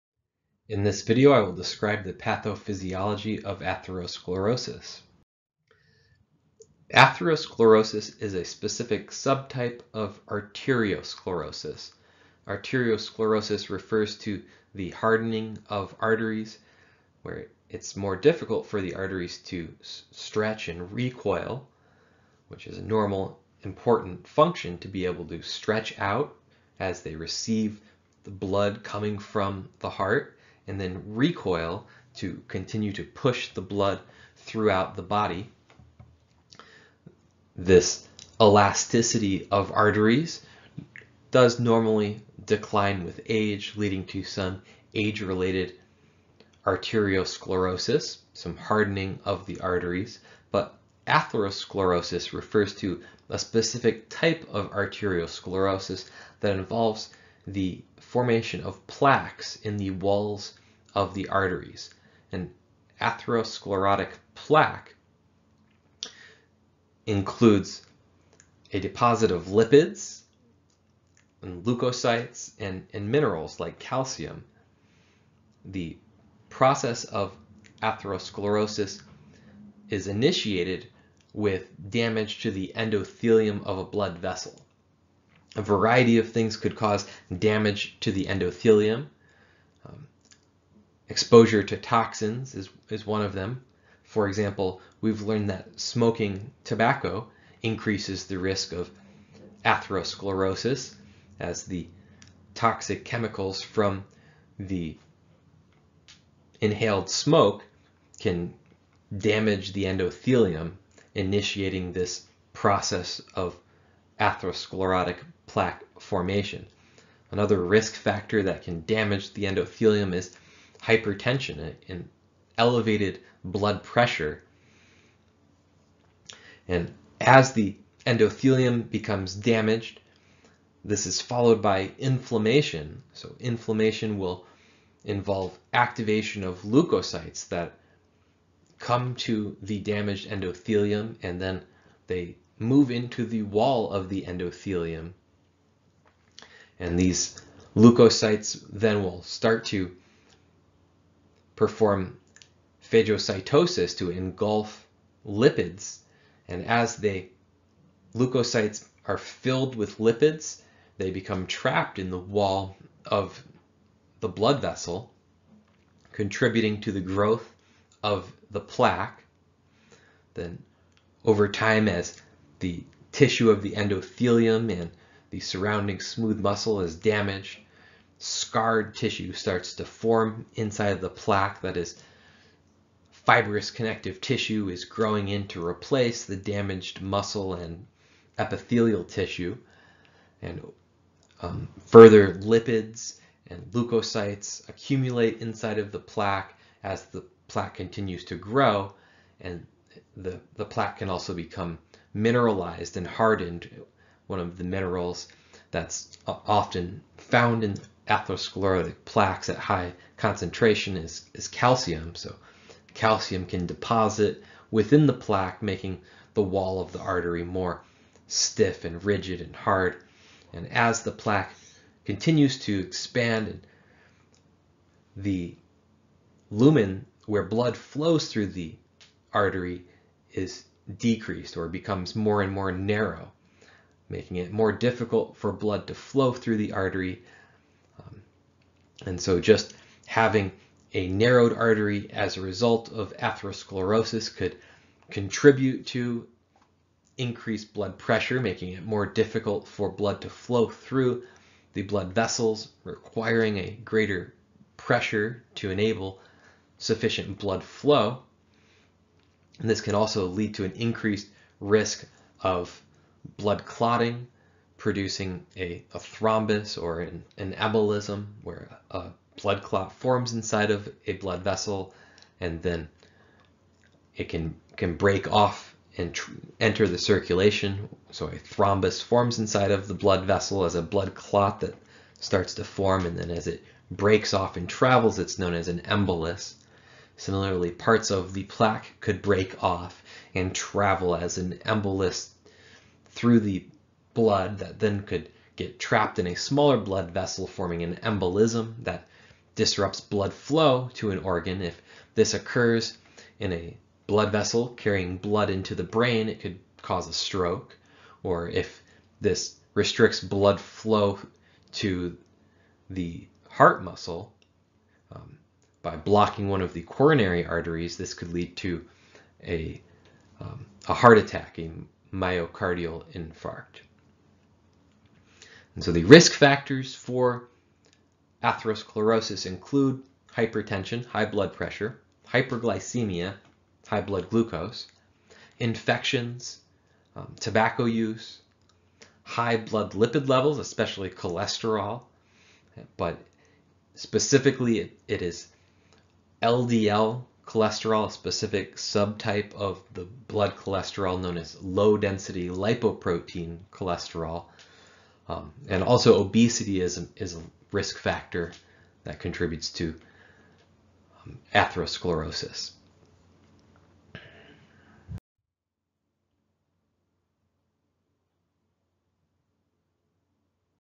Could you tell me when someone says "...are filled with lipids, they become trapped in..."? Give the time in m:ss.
2:39.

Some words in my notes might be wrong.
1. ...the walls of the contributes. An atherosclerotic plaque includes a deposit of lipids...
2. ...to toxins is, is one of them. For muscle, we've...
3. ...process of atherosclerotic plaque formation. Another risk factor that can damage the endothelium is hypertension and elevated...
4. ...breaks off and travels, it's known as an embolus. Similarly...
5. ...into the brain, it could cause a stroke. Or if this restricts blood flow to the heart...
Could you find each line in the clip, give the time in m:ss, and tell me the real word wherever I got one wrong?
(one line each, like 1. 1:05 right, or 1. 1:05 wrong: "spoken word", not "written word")
1. 0:59 wrong: "arteries", not "contributes"
2. 1:31 wrong: "example", not "muscle"
3. 1:52 right
4. 4:43 right
5. 5:05 right.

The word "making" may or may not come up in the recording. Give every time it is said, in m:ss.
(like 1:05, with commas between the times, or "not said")
3:35, 3:54, 4:08.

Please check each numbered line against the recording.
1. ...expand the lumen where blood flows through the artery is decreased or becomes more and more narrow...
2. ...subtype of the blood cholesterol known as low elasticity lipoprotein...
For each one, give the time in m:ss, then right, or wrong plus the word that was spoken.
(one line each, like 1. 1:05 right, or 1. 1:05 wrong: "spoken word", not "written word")
1. 3:42 right
2. 5:48 wrong: "density", not "elasticity".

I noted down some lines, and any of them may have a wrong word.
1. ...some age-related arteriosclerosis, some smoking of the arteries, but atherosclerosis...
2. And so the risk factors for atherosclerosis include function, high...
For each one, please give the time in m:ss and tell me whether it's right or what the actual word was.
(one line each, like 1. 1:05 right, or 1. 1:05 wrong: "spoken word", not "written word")
1. 0:44 wrong: "hardening", not "smoking"
2. 5:25 wrong: "hypertension", not "function".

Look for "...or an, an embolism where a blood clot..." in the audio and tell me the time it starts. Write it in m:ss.
4:26.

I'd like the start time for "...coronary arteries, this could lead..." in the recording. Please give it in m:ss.
5:16.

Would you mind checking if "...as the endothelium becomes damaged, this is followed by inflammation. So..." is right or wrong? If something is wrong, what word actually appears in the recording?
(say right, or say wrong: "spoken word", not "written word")
right.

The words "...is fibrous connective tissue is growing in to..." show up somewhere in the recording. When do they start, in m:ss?
3:01.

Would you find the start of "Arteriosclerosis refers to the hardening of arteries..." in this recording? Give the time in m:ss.
0:12.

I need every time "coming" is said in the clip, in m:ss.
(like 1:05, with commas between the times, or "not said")
0:28.